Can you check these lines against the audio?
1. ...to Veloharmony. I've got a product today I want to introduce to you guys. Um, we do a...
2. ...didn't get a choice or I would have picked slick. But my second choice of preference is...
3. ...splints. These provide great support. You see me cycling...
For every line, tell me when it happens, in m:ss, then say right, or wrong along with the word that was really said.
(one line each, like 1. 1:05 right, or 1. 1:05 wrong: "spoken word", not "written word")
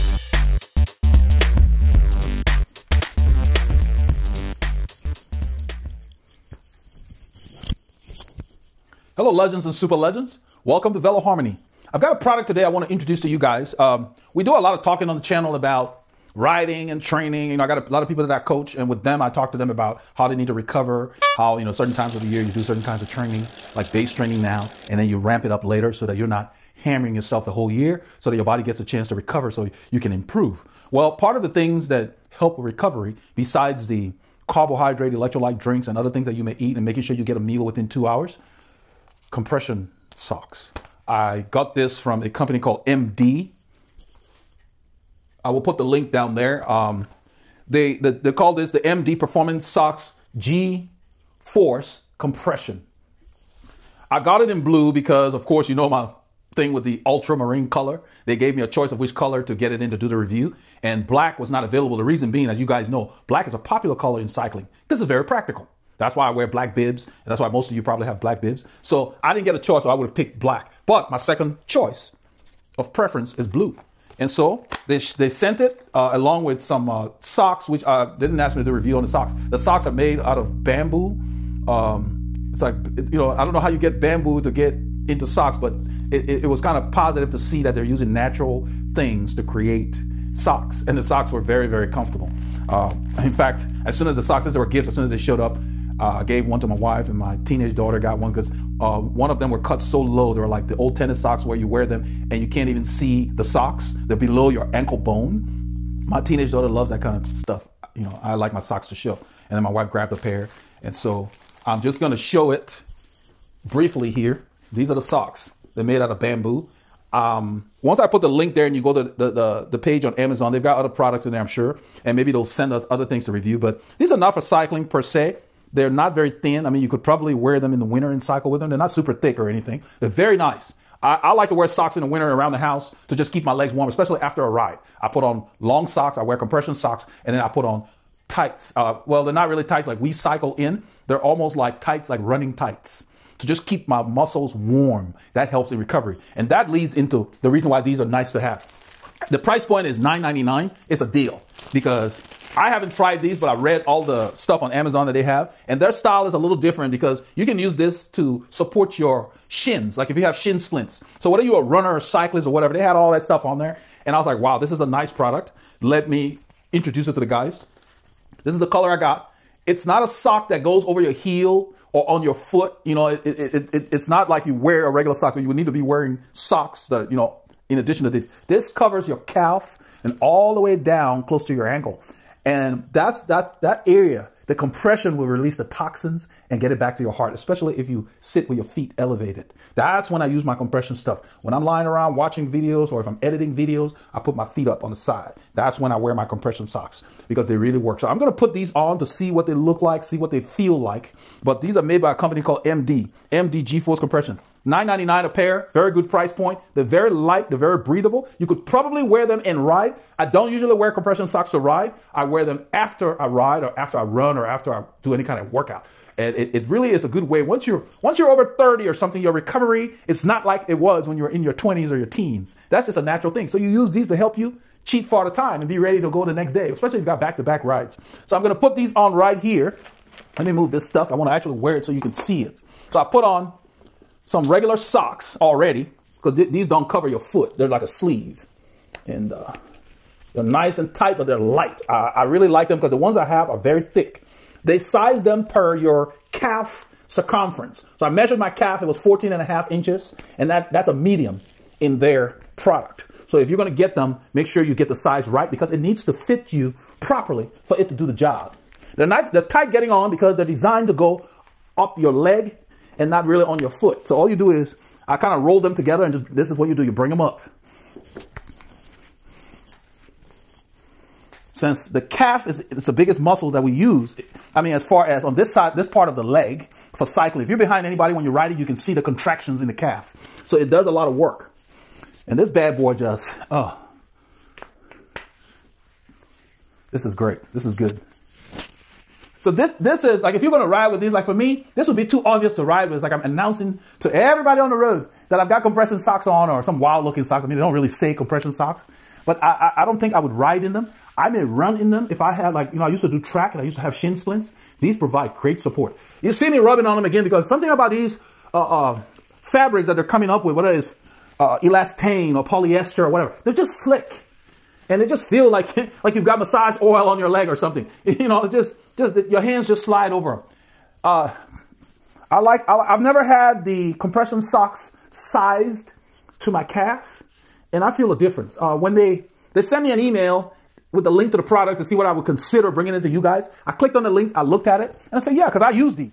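1. 0:10 right
2. 1:09 wrong: "black", not "slick"
3. 5:04 wrong: "rubbing", not "cycling".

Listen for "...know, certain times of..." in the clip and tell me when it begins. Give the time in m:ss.
0:21.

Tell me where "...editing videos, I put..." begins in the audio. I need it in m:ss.
3:13.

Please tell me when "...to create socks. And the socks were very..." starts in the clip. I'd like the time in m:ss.
1:29.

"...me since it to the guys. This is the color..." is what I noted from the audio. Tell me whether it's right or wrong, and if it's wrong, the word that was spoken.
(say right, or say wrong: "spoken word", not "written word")
wrong: "introduce", not "since".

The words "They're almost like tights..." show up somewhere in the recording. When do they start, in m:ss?
2:21.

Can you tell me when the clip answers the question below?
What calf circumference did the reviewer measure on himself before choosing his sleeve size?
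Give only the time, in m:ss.
4:08.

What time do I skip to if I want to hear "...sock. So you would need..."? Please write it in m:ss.
2:55.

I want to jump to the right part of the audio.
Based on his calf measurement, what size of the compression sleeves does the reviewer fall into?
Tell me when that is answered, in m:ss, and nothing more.
4:10.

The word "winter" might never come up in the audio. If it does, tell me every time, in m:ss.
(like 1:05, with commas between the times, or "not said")
2:07, 2:12.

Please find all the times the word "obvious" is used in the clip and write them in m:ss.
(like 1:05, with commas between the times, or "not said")
4:52.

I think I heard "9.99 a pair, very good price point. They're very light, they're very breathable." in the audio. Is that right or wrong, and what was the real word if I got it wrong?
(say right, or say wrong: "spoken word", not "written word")
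right.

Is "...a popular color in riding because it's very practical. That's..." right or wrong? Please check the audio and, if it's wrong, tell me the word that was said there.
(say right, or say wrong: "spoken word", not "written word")
wrong: "cycling", not "riding".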